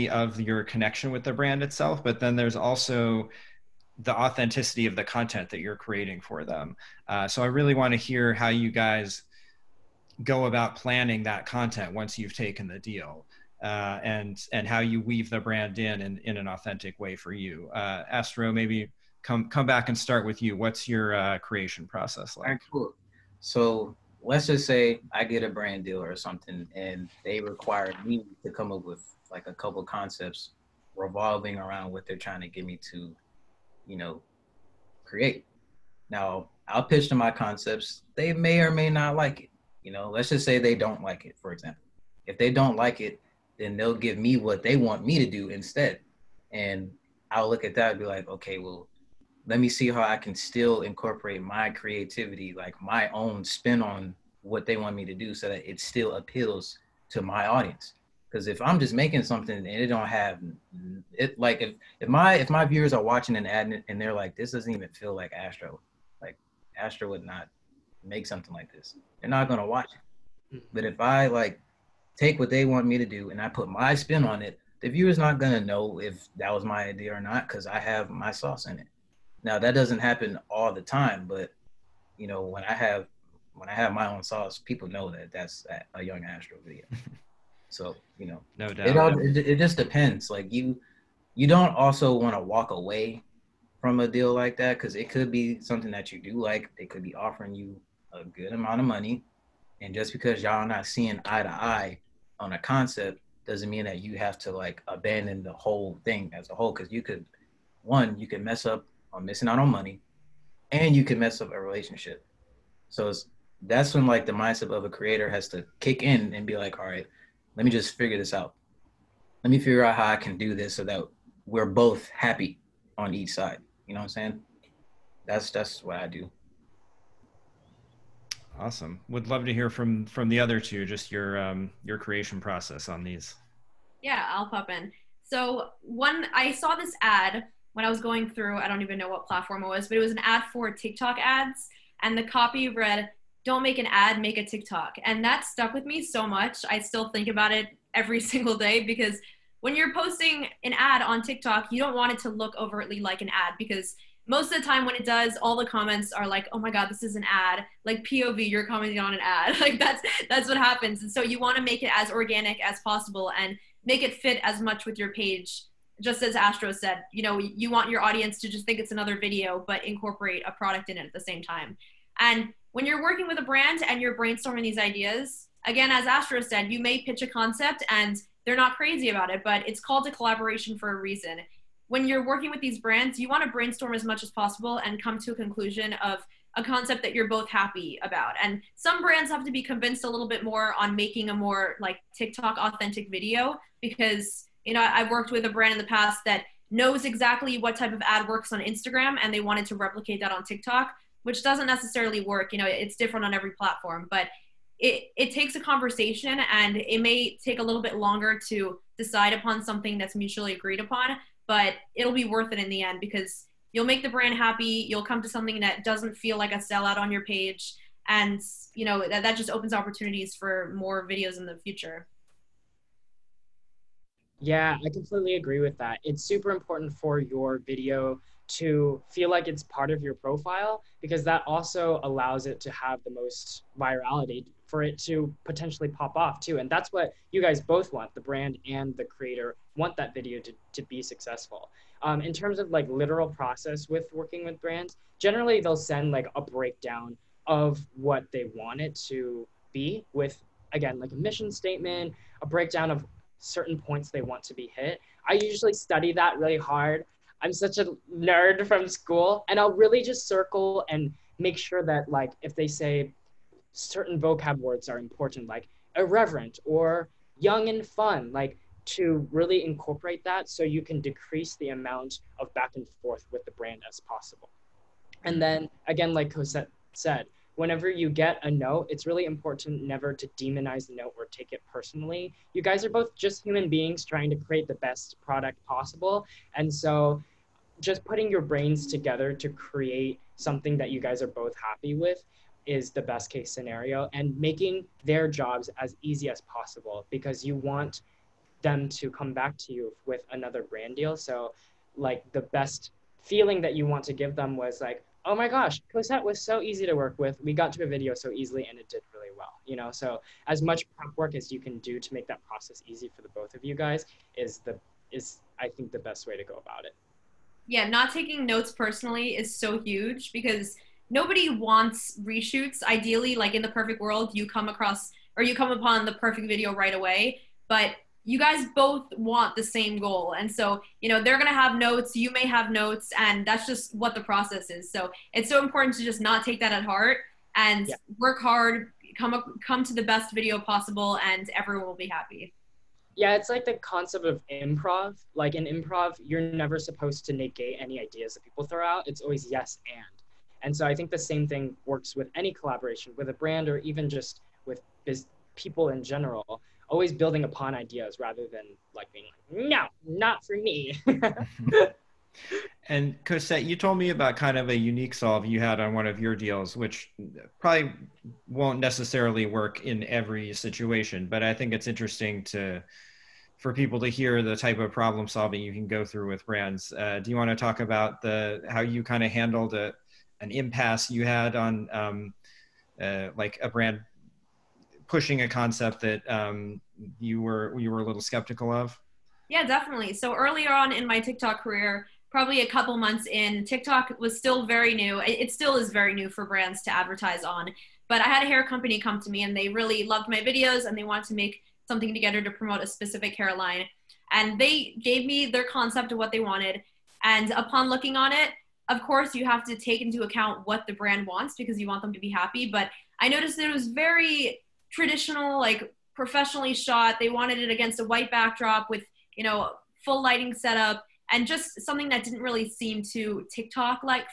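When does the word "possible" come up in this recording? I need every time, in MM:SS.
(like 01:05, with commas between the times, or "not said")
02:42, 03:04, 04:34, 04:45, 04:56, 05:40.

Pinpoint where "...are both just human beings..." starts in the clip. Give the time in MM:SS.
04:42.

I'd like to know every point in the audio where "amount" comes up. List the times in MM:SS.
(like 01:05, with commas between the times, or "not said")
01:38, 04:31.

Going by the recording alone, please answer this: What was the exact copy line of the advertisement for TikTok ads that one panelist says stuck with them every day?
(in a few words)
Don't make an ad, make a TikTok.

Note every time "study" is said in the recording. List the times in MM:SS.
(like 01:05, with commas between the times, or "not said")
04:15.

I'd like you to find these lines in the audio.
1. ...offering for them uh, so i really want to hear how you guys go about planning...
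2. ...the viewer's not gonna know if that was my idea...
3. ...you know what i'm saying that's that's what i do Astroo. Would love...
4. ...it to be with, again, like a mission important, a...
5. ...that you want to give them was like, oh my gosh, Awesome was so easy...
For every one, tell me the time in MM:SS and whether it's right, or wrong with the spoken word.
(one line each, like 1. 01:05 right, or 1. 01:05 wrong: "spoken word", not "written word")
1. 00:05 wrong: "creating", not "offering"
2. 01:14 right
3. 02:03 wrong: "Awesome", not "Astroo"
4. 04:08 wrong: "statement", not "important"
5. 05:03 wrong: "Cosette", not "Awesome".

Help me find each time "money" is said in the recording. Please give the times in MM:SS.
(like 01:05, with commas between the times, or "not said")
01:38, 01:49.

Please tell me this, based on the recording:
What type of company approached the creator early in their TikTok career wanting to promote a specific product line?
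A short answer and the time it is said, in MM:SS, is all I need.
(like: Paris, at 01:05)
a hair company, at 06:38.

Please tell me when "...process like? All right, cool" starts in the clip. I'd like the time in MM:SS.
00:21.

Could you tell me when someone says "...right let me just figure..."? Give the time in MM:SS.
01:56.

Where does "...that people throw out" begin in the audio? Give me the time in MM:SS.
05:48.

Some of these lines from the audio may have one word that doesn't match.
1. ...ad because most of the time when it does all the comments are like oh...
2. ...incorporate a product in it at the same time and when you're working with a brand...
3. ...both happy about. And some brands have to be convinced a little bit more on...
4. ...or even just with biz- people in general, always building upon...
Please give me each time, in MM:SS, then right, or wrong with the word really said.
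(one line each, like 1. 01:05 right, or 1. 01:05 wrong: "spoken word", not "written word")
1. 02:33 right
2. 02:49 right
3. 03:07 right
4. 05:53 right.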